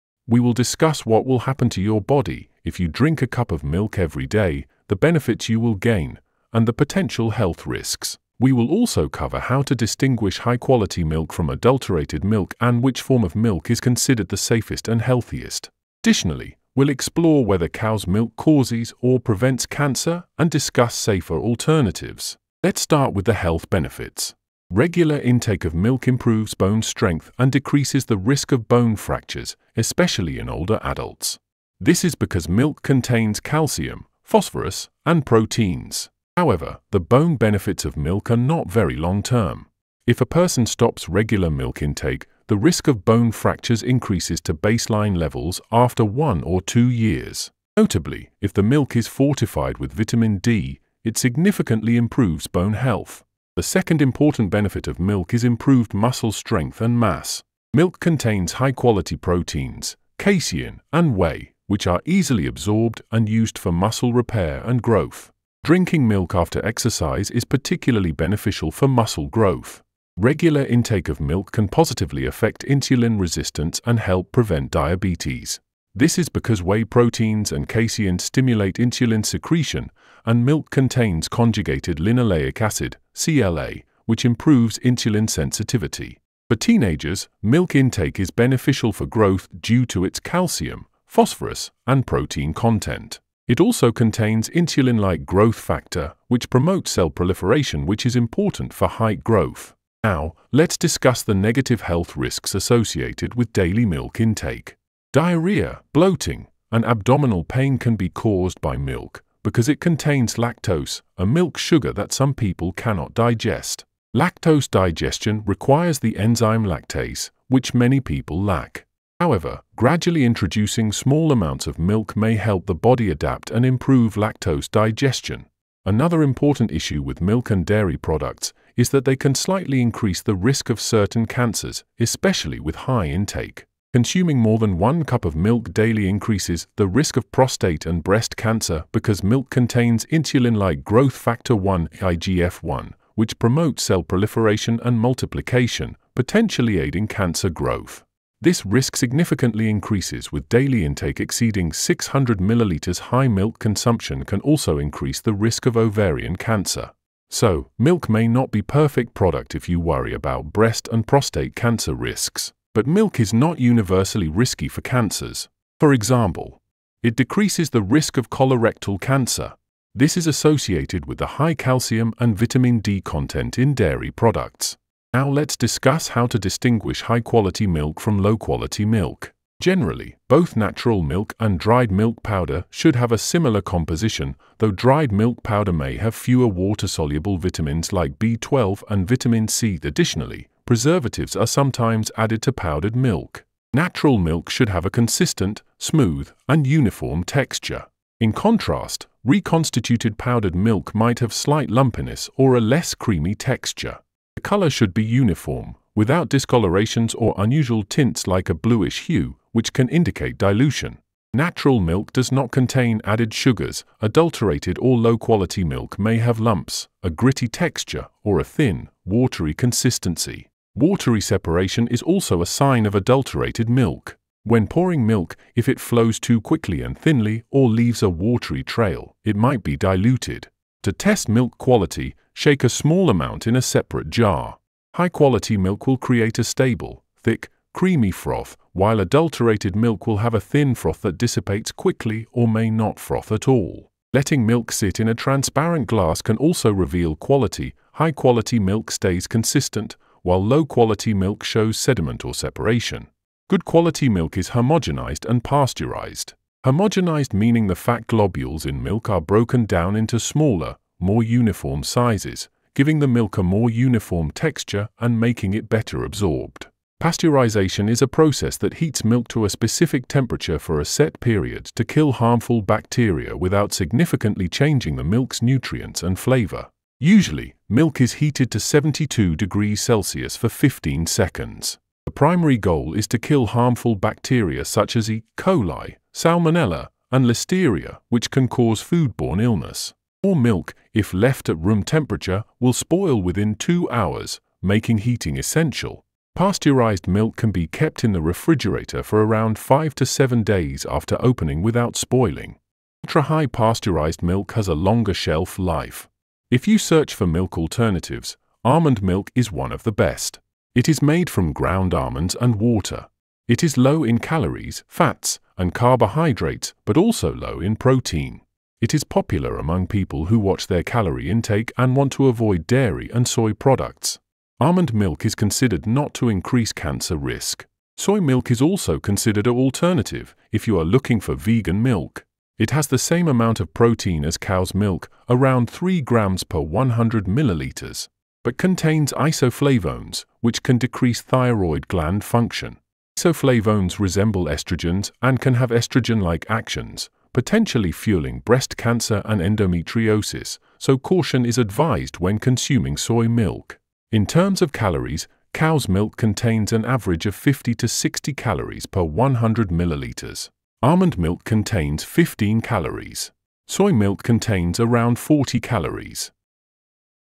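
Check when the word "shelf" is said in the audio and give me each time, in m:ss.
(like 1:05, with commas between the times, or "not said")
5:05.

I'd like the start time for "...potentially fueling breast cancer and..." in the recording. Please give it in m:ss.
5:47.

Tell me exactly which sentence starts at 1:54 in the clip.
Lactose digestion requires the enzyme lactase, which many people lack.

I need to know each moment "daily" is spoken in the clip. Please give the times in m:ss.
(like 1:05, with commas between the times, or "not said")
1:43, 2:15, 2:30.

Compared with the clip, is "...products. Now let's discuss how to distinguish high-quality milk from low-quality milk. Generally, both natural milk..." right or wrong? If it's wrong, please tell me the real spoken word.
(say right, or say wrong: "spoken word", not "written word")
right.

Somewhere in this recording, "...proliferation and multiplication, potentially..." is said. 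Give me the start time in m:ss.
2:24.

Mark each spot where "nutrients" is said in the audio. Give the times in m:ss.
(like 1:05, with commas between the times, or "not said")
4:35.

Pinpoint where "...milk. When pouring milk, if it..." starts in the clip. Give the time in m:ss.
3:43.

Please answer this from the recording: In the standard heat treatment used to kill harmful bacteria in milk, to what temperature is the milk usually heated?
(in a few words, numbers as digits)
72 degrees Celsius.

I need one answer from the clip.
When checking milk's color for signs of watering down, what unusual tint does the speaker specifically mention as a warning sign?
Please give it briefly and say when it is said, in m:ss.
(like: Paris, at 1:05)
bluish hue, at 3:28.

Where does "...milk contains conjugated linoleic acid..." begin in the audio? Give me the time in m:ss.
1:20.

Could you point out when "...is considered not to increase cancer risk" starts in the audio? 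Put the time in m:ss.
5:25.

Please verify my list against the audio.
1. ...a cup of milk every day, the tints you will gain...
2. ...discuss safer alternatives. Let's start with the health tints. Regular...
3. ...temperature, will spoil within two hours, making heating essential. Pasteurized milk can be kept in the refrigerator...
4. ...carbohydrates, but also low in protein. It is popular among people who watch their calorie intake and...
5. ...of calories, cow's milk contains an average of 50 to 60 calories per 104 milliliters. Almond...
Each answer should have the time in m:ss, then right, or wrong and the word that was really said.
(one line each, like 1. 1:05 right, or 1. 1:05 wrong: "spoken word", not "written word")
1. 0:03 wrong: "benefits", not "tints"
2. 0:20 wrong: "benefits", not "tints"
3. 4:51 right
4. 5:15 right
5. 5:54 wrong: "100", not "104".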